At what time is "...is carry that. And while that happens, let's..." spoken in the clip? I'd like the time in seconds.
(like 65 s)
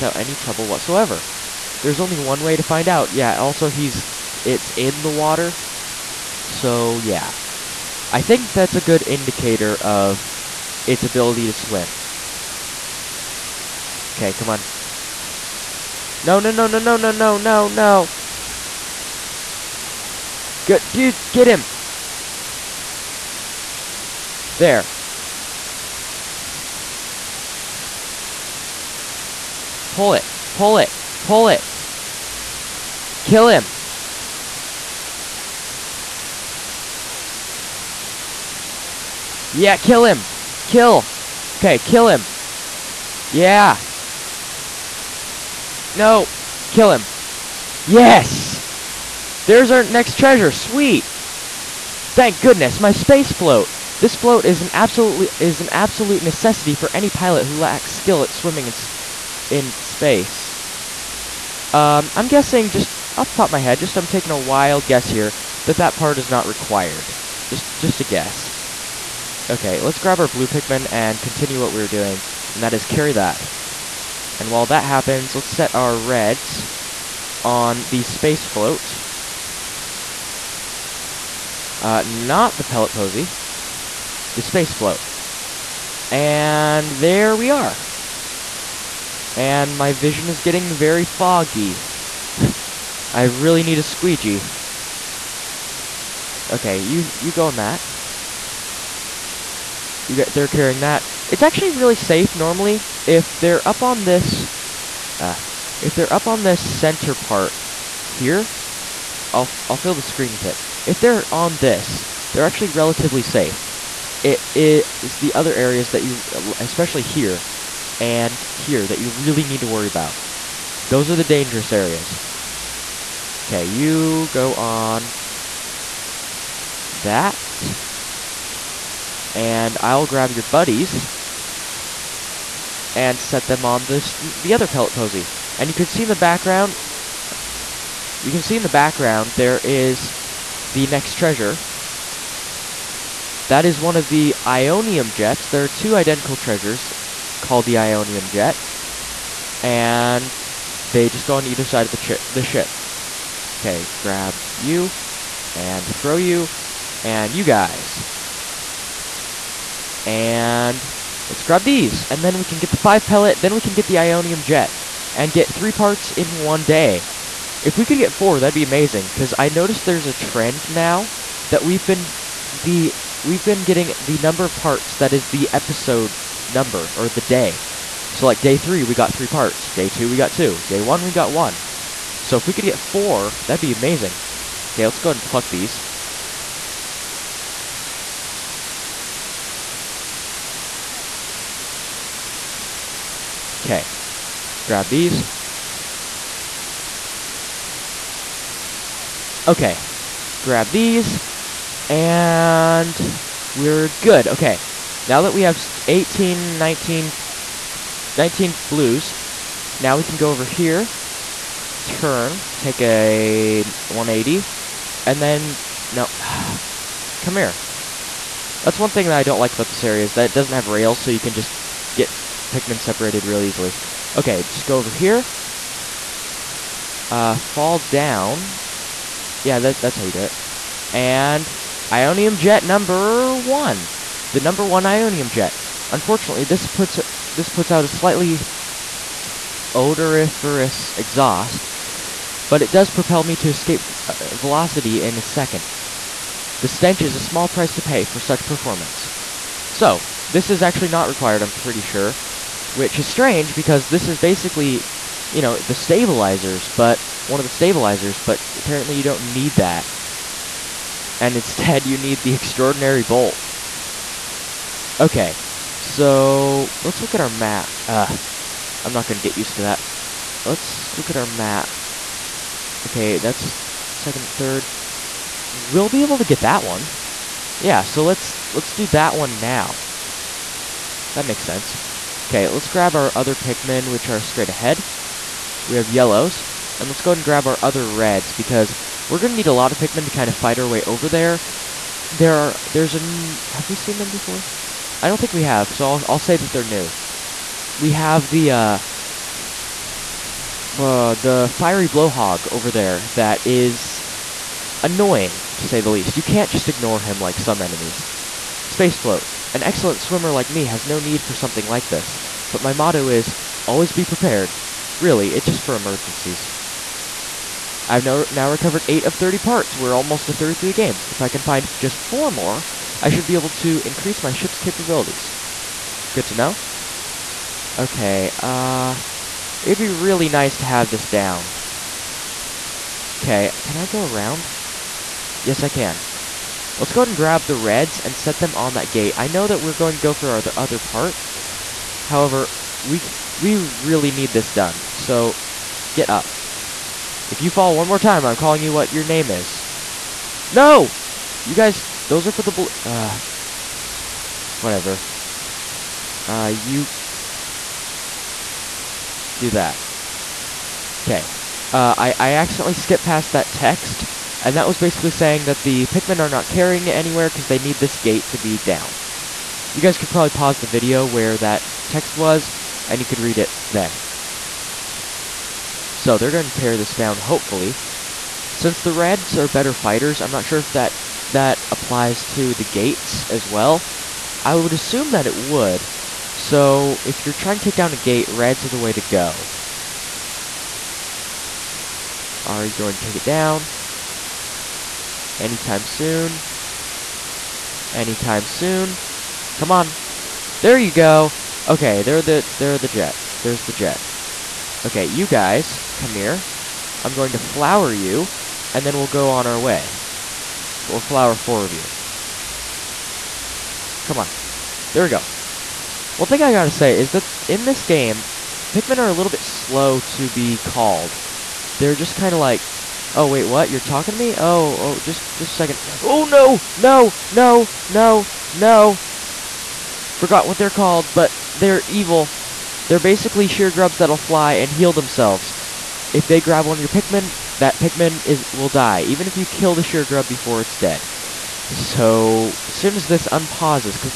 72 s.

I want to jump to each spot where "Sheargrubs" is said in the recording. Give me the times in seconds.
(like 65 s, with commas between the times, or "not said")
433 s, 439 s.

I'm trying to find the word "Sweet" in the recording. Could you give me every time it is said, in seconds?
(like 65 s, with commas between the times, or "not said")
50 s.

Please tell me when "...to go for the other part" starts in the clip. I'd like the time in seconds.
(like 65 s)
339 s.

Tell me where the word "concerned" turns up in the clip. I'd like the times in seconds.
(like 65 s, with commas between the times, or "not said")
not said.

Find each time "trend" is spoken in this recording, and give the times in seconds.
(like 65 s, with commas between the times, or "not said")
170 s.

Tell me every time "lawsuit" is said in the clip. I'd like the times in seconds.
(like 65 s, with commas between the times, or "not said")
not said.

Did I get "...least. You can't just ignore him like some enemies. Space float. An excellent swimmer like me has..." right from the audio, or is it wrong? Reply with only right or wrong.
right.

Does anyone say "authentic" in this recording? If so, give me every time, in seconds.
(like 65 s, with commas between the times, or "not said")
not said.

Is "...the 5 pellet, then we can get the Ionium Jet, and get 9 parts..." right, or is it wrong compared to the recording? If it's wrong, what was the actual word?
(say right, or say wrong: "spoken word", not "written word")
wrong: "3", not "9".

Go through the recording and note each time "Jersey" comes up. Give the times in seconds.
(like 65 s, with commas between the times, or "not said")
not said.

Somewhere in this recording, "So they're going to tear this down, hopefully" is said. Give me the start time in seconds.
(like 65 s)
375 s.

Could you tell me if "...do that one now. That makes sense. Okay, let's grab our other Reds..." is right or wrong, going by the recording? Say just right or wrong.
wrong.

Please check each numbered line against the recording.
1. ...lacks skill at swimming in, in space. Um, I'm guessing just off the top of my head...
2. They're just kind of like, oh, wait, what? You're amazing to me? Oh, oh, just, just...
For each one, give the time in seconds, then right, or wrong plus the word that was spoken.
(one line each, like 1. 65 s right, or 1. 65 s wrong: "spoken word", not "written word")
1. 57 s right
2. 421 s wrong: "talking", not "amazing".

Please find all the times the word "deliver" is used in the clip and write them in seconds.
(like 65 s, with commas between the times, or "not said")
not said.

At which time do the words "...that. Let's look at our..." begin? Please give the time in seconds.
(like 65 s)
269 s.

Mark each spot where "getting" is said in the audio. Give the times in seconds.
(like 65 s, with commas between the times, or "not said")
90 s, 173 s.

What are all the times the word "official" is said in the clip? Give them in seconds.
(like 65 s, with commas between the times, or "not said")
not said.